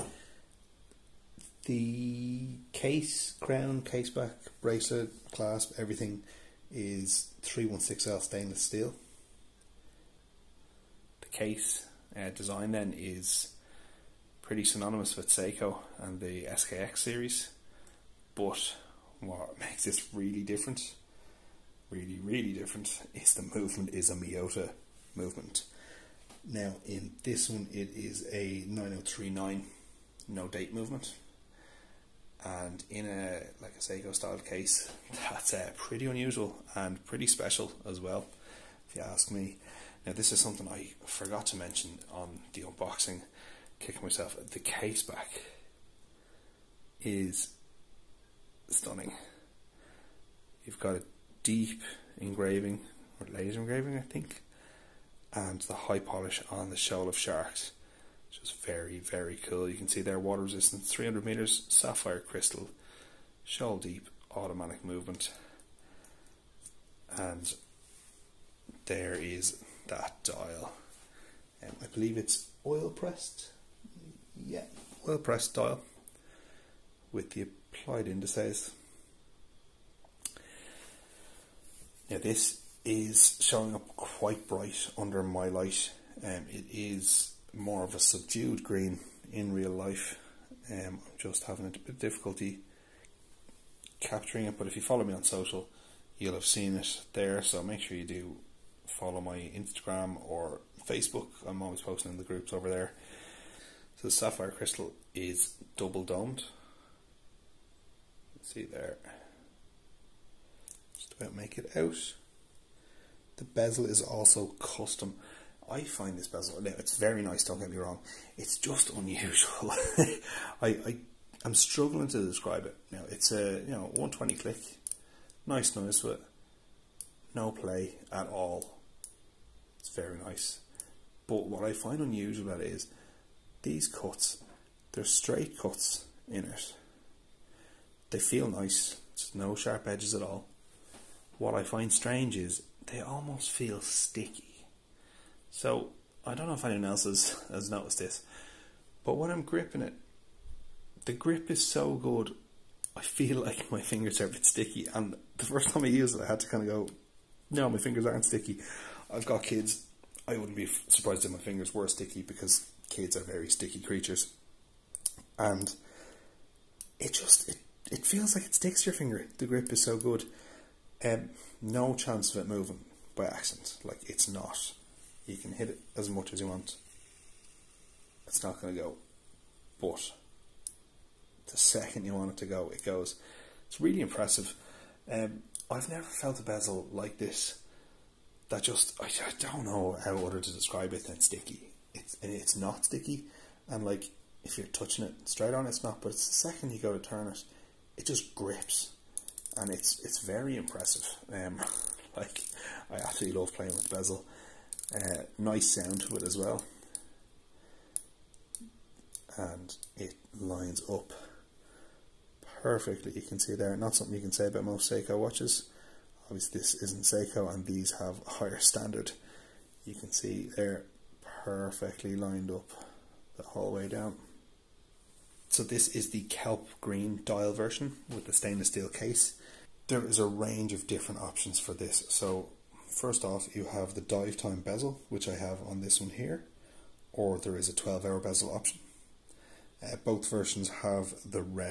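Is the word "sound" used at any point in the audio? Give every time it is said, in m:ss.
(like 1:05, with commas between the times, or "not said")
3:25.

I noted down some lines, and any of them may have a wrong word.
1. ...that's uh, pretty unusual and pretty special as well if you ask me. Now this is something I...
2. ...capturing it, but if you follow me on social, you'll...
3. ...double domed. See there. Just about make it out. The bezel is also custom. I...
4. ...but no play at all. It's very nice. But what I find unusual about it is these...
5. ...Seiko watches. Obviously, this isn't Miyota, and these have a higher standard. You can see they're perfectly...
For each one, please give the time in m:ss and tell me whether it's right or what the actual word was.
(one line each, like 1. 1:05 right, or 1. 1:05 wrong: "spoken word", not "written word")
1. 0:35 right
2. 1:33 right
3. 1:45 right
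4. 2:06 right
5. 3:34 wrong: "Seiko", not "Miyota".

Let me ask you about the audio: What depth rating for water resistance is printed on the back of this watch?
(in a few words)
300 meters.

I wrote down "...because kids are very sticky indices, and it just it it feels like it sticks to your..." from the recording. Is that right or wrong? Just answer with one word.
wrong.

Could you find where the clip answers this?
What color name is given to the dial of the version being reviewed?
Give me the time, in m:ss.
3:46.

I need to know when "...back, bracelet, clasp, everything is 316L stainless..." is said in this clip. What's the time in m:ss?
0:04.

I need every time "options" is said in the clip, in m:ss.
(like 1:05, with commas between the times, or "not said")
3:51, 3:58.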